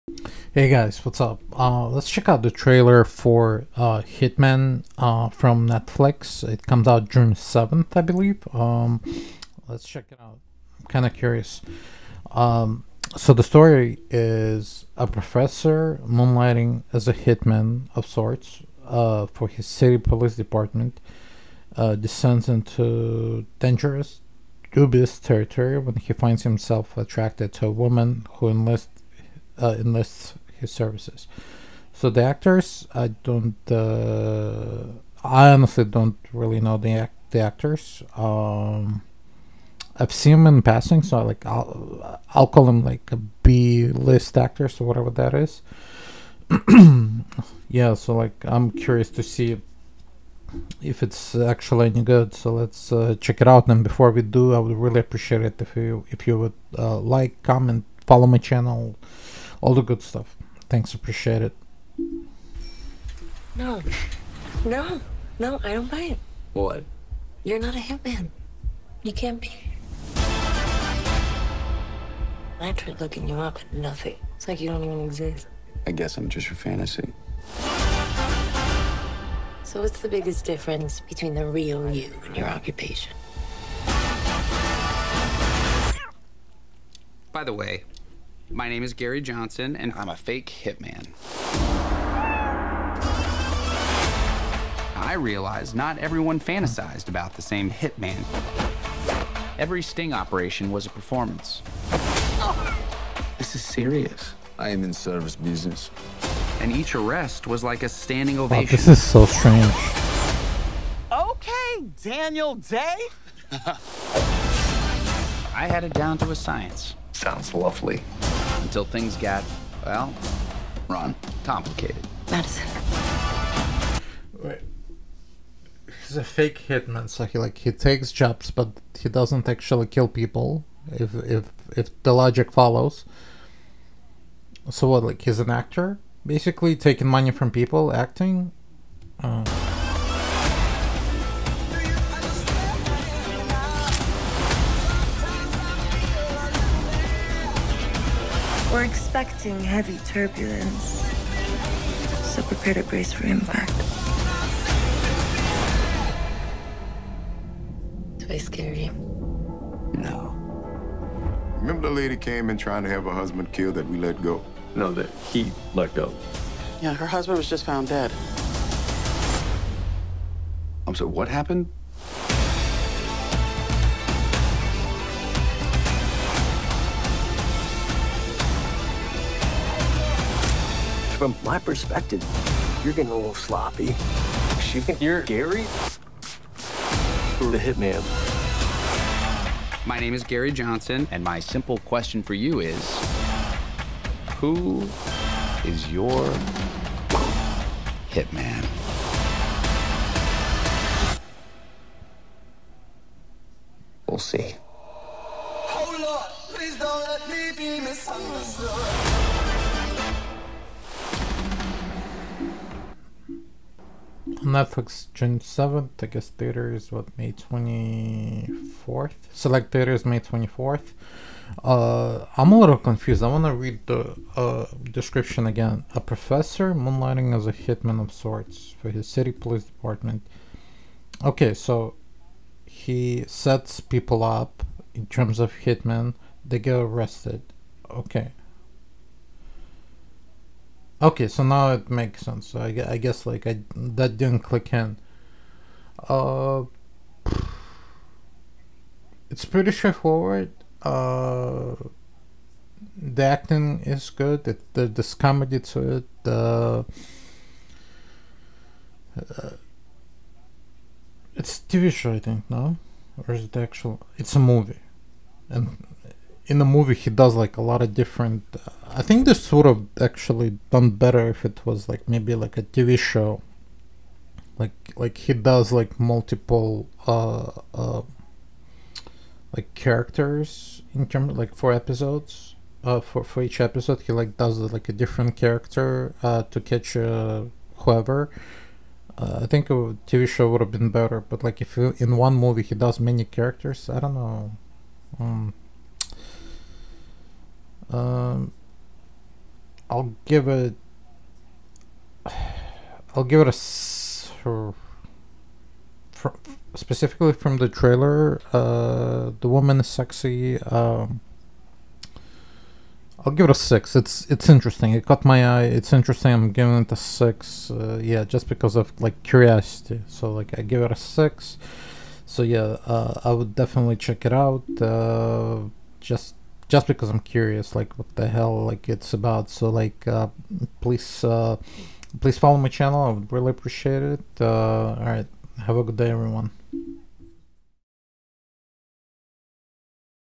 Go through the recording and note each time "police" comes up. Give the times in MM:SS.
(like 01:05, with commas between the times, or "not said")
00:19, 03:49.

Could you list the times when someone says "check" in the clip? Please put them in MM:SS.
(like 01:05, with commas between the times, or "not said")
00:02, 00:09, 00:53, 05:23.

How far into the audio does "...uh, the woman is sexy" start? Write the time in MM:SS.
05:08.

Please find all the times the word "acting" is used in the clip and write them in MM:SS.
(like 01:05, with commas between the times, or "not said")
02:17, 04:13.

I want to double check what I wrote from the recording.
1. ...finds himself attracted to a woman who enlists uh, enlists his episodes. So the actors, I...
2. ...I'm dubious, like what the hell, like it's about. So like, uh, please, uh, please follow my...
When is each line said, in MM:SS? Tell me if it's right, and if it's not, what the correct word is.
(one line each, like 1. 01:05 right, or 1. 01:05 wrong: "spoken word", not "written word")
1. 00:26 wrong: "services", not "episodes"
2. 05:27 wrong: "curious", not "dubious".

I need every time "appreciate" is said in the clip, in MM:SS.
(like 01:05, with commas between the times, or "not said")
00:55, 01:00, 05:33.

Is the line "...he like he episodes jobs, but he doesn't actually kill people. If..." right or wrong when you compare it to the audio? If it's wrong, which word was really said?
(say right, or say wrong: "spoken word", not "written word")
wrong: "takes", not "episodes".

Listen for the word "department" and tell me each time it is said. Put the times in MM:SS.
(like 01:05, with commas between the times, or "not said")
00:20, 03:49.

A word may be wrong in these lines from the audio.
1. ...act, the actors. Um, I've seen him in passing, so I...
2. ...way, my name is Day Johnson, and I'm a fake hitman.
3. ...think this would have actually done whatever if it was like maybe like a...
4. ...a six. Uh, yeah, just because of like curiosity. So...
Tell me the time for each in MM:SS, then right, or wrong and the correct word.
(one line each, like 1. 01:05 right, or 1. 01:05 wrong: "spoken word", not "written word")
1. 00:36 right
2. 01:27 wrong: "Gary", not "Day"
3. 04:29 wrong: "better", not "whatever"
4. 05:16 right.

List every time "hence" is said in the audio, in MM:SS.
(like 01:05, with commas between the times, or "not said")
not said.